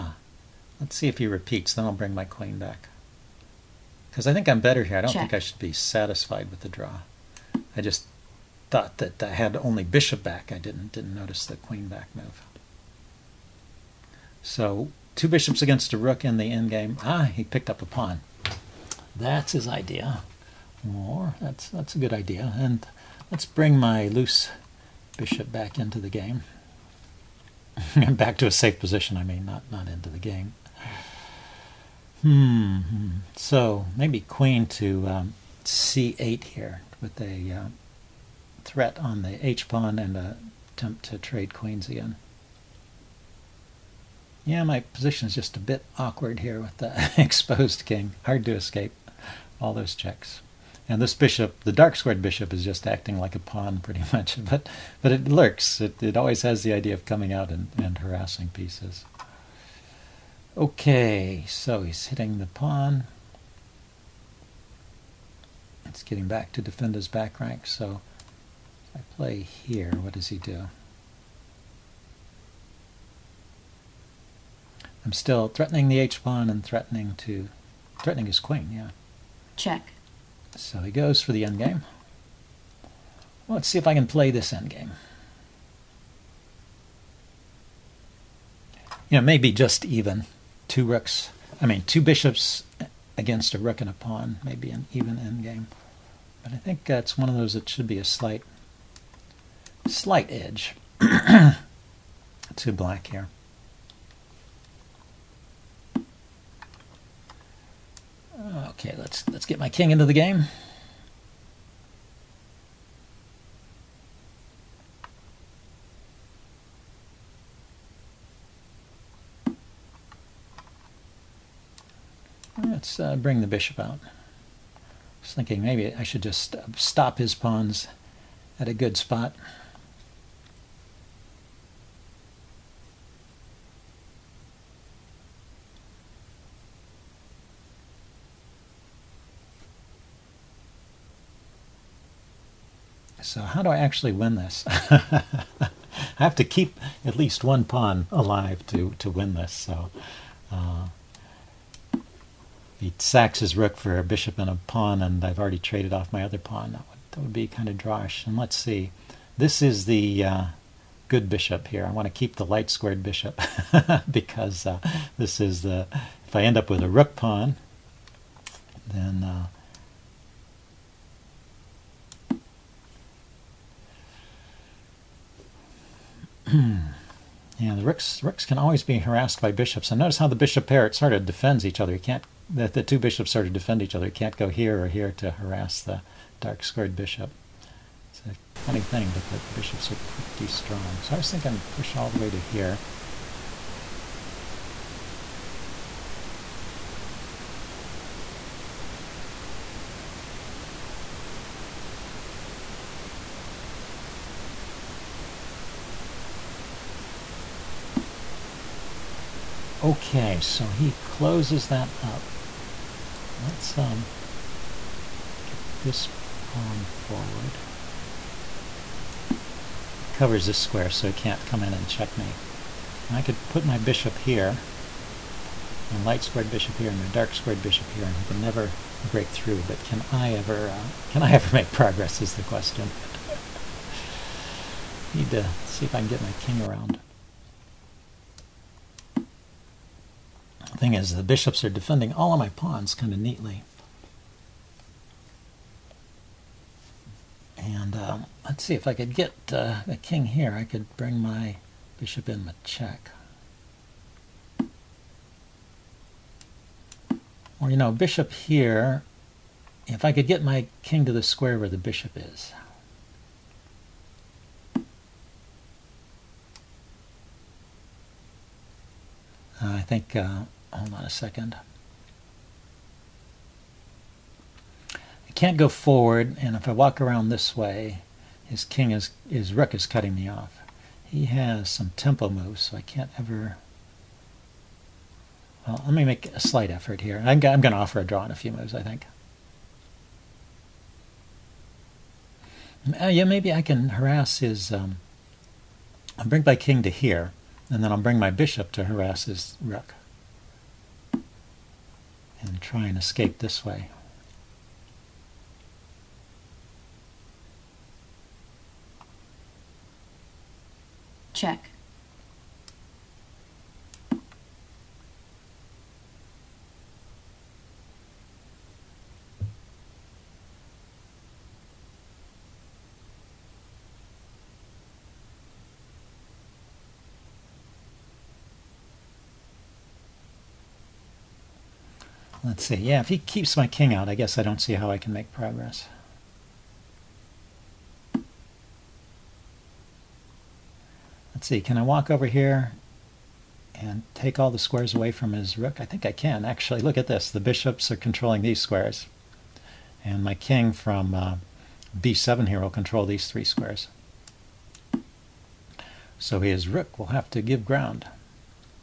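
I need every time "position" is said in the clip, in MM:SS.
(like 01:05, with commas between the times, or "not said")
00:28, 00:44.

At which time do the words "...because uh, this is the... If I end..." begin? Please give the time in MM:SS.
02:44.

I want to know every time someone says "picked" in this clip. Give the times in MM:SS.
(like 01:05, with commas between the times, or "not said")
00:17.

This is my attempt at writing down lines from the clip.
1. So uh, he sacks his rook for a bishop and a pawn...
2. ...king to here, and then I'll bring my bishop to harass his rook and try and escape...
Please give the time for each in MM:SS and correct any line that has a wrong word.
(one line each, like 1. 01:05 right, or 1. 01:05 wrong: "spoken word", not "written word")
1. 02:29 right
2. 04:56 right.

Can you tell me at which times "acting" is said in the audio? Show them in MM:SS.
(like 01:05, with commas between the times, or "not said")
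00:52.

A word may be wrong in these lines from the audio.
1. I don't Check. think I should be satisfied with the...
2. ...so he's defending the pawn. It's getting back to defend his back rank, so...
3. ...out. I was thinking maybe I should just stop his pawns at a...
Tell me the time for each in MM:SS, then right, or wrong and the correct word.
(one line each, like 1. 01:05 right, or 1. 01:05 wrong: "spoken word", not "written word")
1. 00:04 right
2. 01:01 wrong: "hitting", not "defending"
3. 02:03 right.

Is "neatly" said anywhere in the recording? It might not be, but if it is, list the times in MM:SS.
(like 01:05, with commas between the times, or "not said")
04:03.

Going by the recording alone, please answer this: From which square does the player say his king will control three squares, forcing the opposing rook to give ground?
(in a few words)
b7.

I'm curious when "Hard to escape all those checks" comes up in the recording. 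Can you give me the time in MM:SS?
00:48.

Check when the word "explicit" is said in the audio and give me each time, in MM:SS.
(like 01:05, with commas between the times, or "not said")
not said.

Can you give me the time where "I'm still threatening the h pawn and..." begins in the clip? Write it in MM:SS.
01:15.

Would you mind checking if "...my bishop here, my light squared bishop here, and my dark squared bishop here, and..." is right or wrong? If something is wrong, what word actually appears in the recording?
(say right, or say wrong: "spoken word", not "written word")
right.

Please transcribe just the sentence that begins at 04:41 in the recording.
He has some tempo moves, so I can't ever.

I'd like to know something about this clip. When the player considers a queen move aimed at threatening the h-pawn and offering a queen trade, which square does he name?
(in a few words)
c8.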